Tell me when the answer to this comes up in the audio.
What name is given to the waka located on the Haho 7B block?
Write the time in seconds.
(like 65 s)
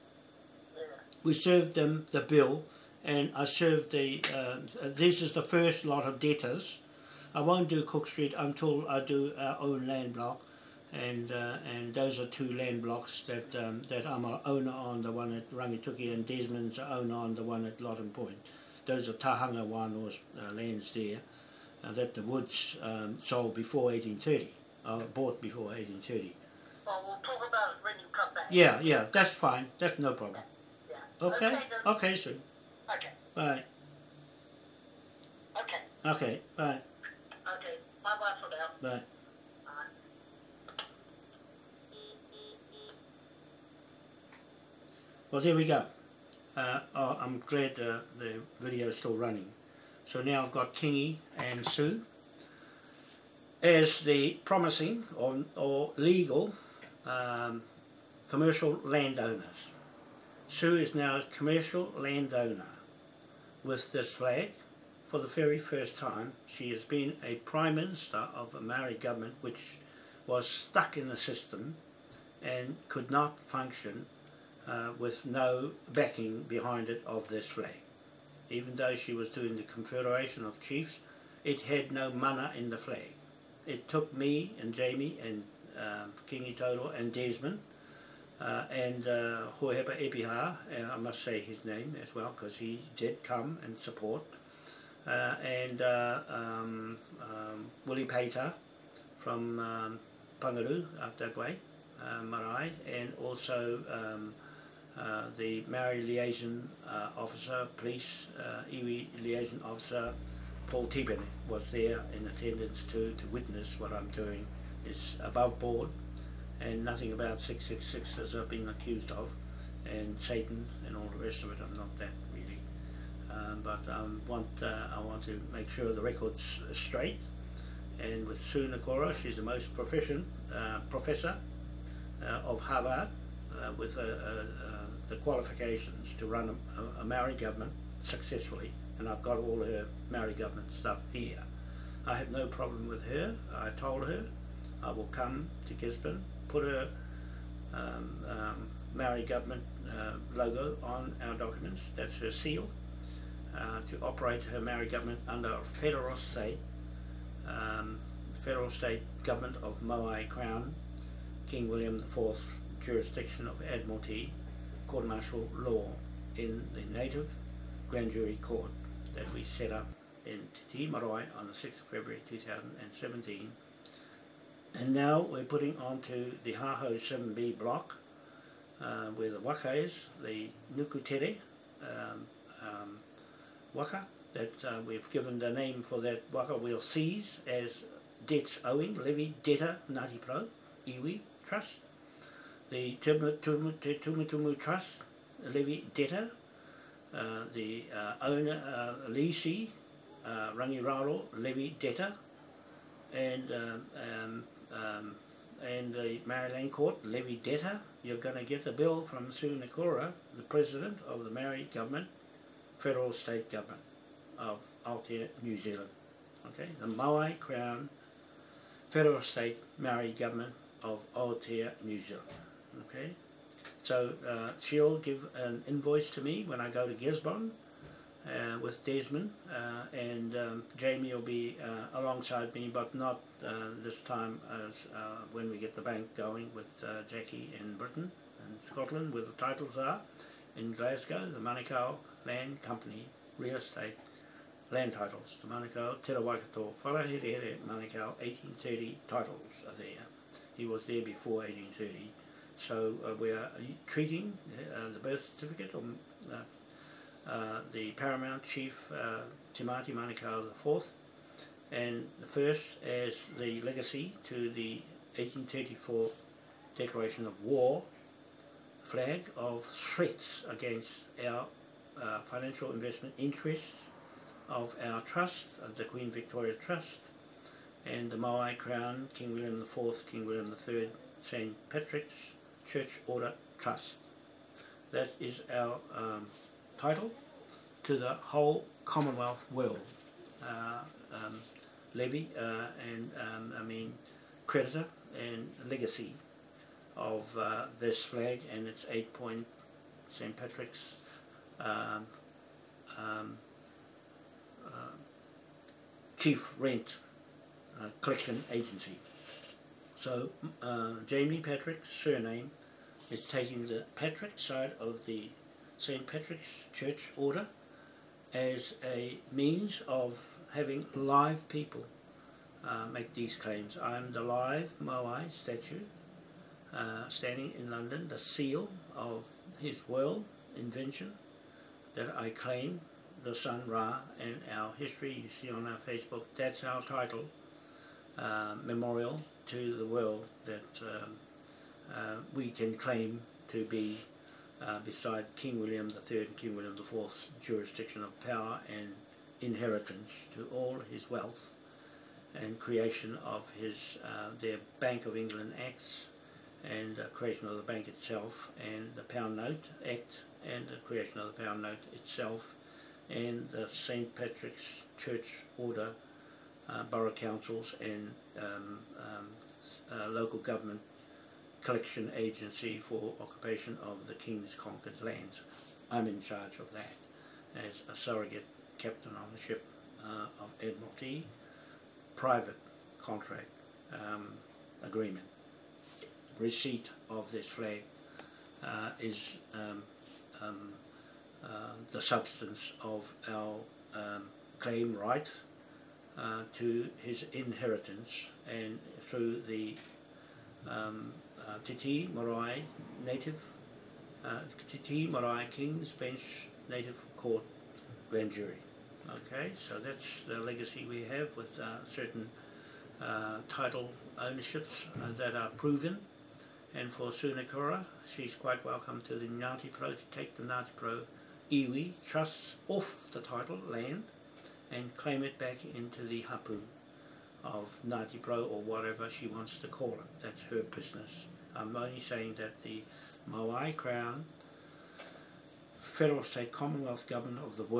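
180 s.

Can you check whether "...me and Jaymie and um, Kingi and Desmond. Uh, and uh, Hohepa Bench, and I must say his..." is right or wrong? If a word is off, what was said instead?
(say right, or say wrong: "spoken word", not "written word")
wrong: "Epiha", not "Bench".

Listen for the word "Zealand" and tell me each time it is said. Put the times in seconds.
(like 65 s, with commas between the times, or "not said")
215 s, 222 s.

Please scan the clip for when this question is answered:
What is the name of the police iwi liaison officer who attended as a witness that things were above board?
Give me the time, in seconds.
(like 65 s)
110 s.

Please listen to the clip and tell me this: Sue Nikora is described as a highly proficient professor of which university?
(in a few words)
Harvard.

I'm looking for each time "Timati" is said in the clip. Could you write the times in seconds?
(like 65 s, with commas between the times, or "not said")
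259 s.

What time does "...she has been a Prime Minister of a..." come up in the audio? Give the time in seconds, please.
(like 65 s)
66 s.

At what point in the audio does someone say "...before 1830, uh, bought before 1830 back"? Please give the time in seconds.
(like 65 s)
23 s.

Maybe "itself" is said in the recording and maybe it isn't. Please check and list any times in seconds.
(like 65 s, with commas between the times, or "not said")
357 s, 361 s.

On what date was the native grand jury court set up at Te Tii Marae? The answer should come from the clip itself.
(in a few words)
6 February 2017.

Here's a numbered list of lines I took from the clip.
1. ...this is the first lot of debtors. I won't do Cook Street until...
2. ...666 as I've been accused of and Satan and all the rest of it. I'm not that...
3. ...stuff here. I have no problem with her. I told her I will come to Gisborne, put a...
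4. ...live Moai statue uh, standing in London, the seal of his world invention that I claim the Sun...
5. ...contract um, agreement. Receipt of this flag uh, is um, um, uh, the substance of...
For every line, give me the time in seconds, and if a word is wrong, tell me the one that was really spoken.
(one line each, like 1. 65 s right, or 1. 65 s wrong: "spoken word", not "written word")
1. 4 s right
2. 117 s right
3. 140 s right
4. 324 s right
5. 383 s right.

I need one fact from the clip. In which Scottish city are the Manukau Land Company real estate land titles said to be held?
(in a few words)
Glasgow.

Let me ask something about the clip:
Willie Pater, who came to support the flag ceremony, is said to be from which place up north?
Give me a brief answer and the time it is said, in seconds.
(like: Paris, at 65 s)
Pangaru, at 100 s.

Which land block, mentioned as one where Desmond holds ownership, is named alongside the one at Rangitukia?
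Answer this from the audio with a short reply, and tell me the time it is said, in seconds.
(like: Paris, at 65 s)
Lottin Point, at 17 s.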